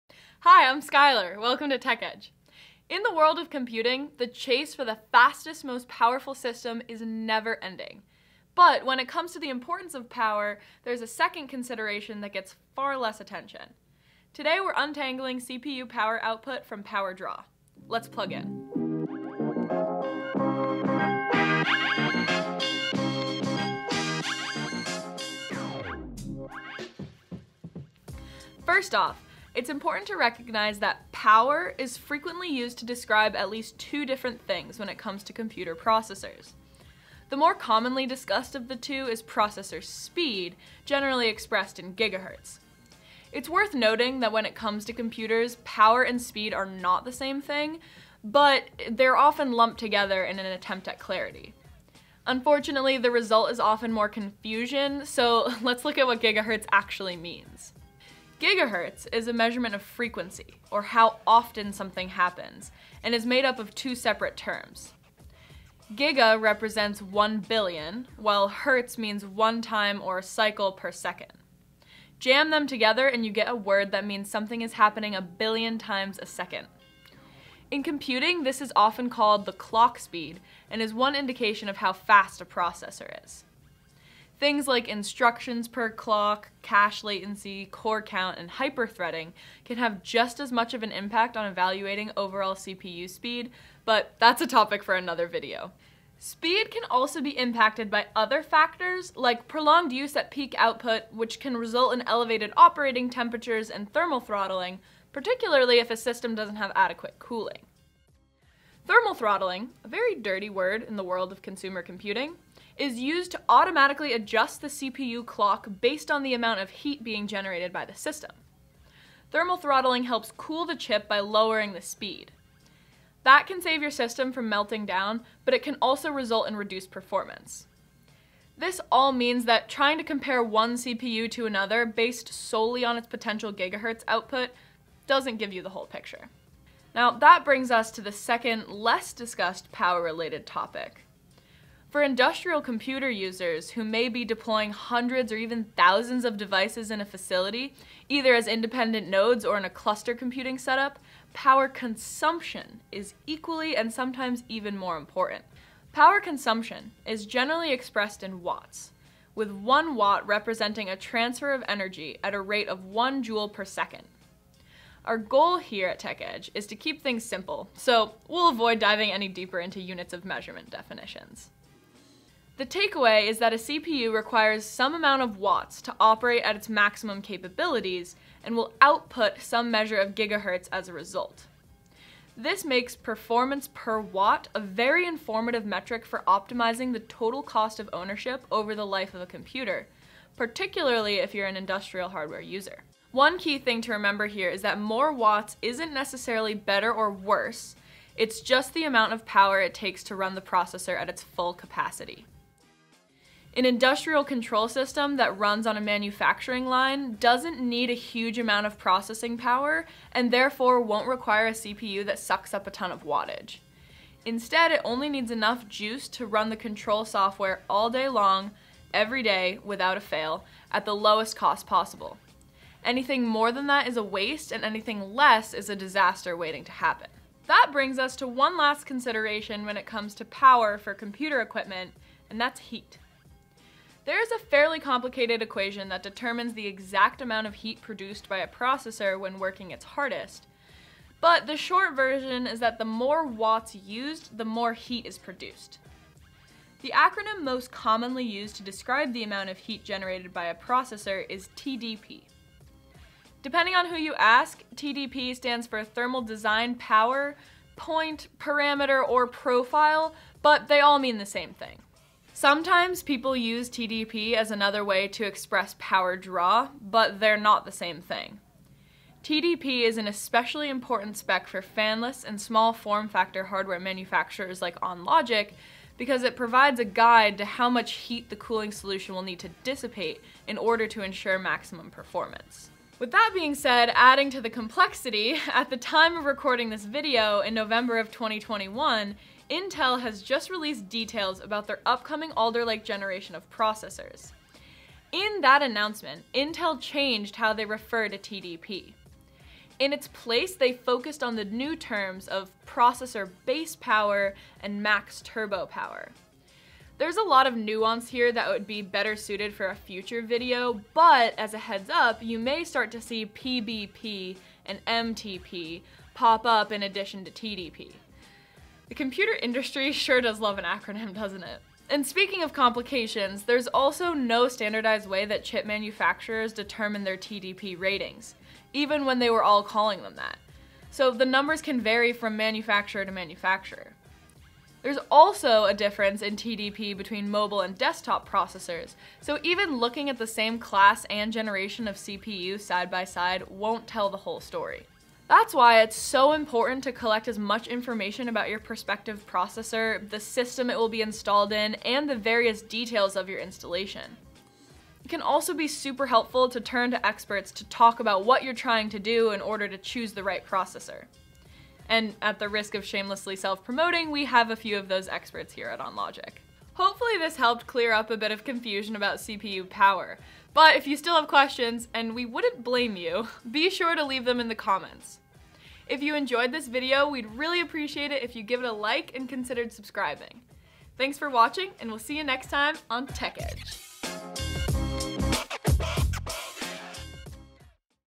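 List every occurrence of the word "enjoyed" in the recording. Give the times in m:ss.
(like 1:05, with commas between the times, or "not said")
6:16.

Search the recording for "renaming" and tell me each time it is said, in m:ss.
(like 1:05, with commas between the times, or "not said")
not said.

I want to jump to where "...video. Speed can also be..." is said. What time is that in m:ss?
1:35.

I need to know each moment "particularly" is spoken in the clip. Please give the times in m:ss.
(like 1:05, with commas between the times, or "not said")
1:45, 3:10.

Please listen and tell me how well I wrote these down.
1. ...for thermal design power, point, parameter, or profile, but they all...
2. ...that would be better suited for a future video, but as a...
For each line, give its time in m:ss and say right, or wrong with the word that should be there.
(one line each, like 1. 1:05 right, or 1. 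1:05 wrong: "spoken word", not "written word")
1. 4:15 right
2. 5:08 right.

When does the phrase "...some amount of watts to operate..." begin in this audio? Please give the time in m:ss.
2:54.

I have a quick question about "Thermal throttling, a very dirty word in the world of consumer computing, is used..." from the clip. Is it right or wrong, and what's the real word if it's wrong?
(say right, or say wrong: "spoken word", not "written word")
right.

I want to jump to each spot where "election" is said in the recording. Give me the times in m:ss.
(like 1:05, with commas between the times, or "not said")
not said.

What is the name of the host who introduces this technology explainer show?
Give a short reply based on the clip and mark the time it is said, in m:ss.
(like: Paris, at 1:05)
Skylar, at 0:00.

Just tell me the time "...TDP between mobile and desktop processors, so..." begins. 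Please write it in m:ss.
5:36.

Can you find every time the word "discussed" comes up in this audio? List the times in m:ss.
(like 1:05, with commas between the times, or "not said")
0:38, 2:19.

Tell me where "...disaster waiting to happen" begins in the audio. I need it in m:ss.
3:45.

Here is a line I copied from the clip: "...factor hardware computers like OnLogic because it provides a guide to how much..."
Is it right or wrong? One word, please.
wrong.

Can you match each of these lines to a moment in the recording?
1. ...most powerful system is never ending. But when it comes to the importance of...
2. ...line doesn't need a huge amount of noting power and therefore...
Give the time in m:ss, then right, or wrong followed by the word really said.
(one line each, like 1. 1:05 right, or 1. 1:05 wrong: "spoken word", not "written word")
1. 0:05 right
2. 3:26 wrong: "processing", not "noting".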